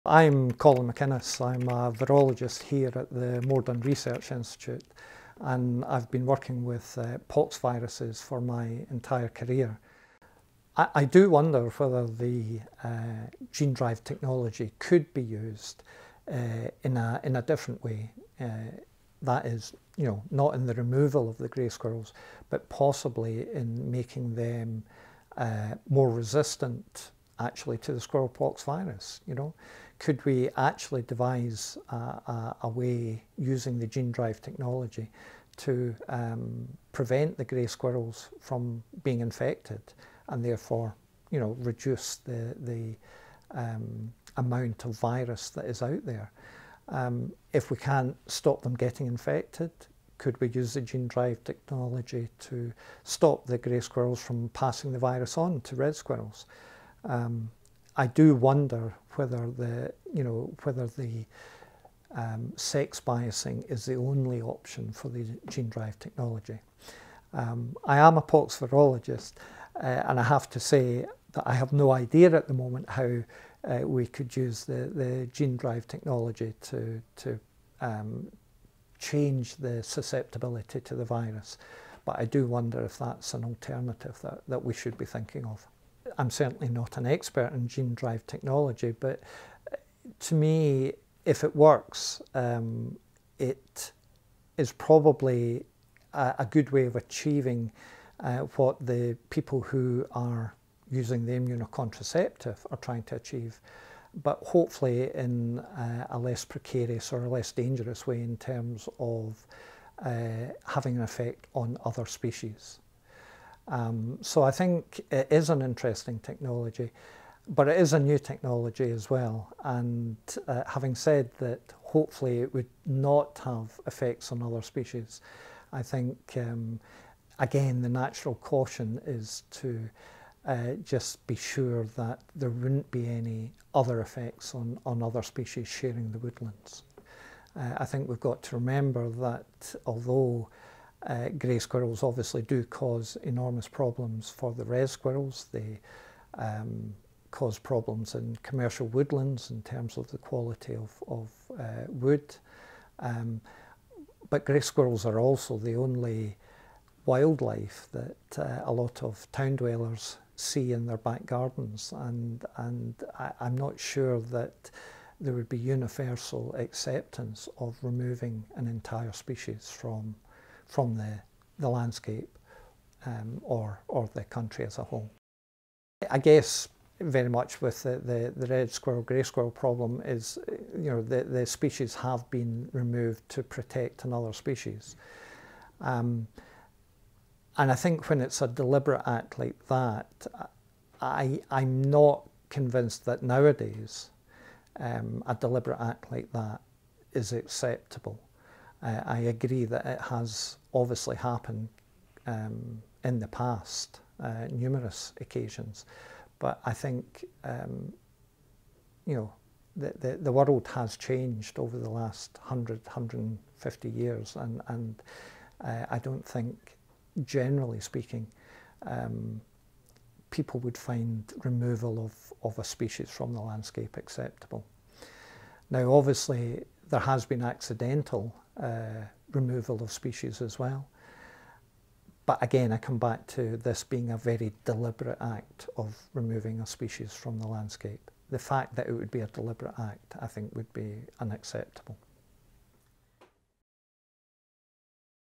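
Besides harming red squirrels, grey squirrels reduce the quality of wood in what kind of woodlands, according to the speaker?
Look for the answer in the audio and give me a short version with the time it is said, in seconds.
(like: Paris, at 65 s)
commercial woodlands, at 148 s.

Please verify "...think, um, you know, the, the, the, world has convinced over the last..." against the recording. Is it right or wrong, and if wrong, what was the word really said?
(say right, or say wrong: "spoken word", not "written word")
wrong: "changed", not "convinced".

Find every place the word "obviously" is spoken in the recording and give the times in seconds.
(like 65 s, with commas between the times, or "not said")
142 s, 200 s, 225 s.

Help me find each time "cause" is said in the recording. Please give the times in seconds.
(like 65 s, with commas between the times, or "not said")
142 s, 147 s.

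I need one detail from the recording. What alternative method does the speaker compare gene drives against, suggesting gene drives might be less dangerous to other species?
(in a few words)
immunocontraceptive.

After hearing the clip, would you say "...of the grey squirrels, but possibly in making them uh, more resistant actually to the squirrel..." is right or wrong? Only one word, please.
right.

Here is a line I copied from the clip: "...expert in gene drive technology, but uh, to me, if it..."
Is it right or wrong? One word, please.
right.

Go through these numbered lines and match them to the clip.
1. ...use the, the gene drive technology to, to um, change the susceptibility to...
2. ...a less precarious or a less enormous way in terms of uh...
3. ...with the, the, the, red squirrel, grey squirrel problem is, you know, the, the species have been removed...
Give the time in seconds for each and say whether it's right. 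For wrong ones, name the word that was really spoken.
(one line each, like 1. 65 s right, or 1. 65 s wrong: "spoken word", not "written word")
1. 74 s right
2. 106 s wrong: "dangerous", not "enormous"
3. 177 s right.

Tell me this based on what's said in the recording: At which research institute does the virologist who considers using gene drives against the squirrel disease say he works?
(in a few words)
Moredun Research Institute.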